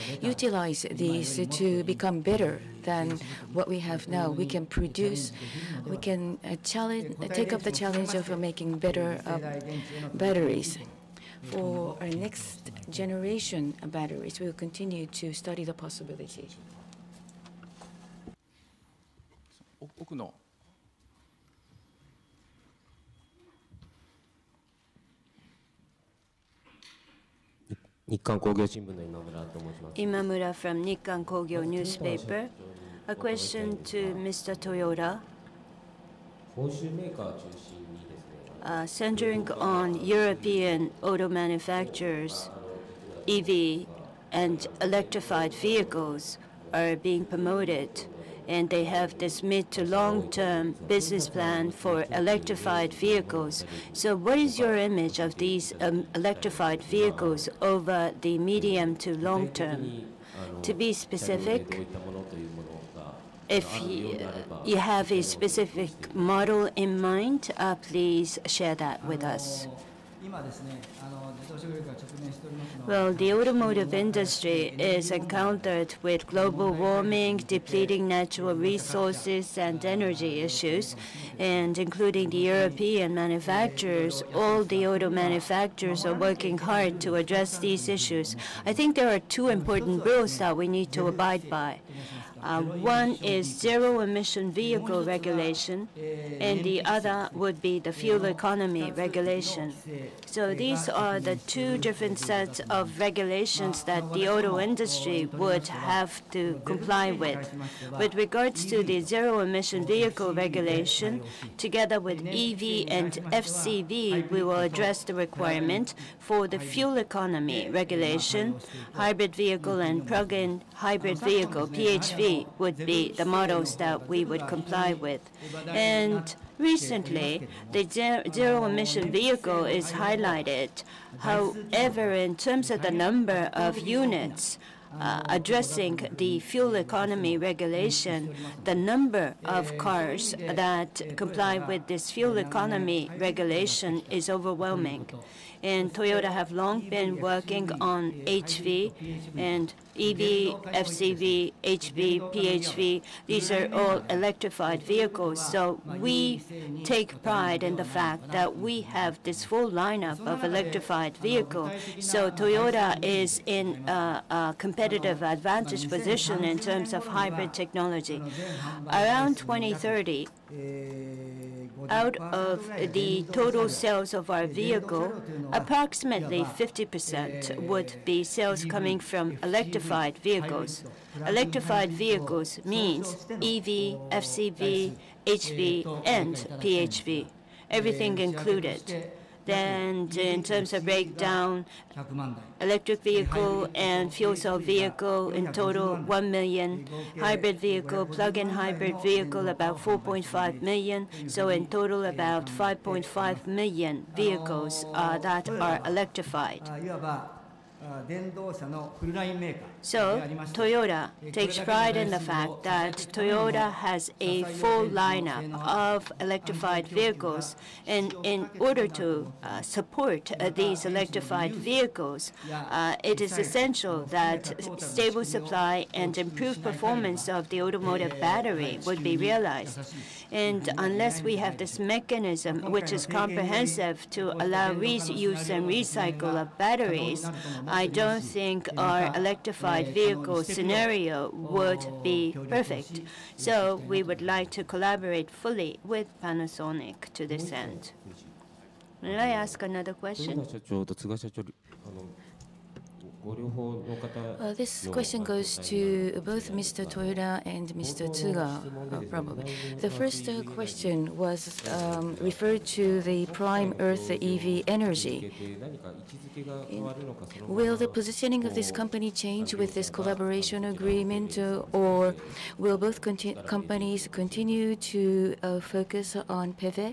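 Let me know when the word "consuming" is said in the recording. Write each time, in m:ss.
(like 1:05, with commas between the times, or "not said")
not said.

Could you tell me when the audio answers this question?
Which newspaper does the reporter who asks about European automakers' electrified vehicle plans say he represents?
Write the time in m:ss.
0:30.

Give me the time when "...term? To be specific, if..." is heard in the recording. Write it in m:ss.
0:59.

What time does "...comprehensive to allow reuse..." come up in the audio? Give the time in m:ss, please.
3:53.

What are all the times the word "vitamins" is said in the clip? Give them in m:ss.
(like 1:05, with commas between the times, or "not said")
not said.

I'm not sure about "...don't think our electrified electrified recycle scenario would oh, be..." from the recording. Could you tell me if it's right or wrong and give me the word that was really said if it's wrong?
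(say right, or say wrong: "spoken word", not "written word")
wrong: "vehicle", not "recycle".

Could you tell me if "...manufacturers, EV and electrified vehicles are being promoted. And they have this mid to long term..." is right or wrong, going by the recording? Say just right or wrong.
right.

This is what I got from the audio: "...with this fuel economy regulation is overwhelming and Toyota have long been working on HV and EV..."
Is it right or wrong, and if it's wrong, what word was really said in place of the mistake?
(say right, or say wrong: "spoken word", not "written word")
right.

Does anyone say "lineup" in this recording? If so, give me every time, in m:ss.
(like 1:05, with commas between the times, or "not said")
2:39, 3:34.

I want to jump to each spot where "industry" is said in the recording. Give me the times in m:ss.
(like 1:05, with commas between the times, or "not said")
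1:13, 1:44.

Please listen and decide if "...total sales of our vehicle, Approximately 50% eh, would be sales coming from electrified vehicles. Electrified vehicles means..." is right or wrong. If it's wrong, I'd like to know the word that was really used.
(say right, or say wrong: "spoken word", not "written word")
right.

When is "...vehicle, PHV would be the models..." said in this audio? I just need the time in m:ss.
2:01.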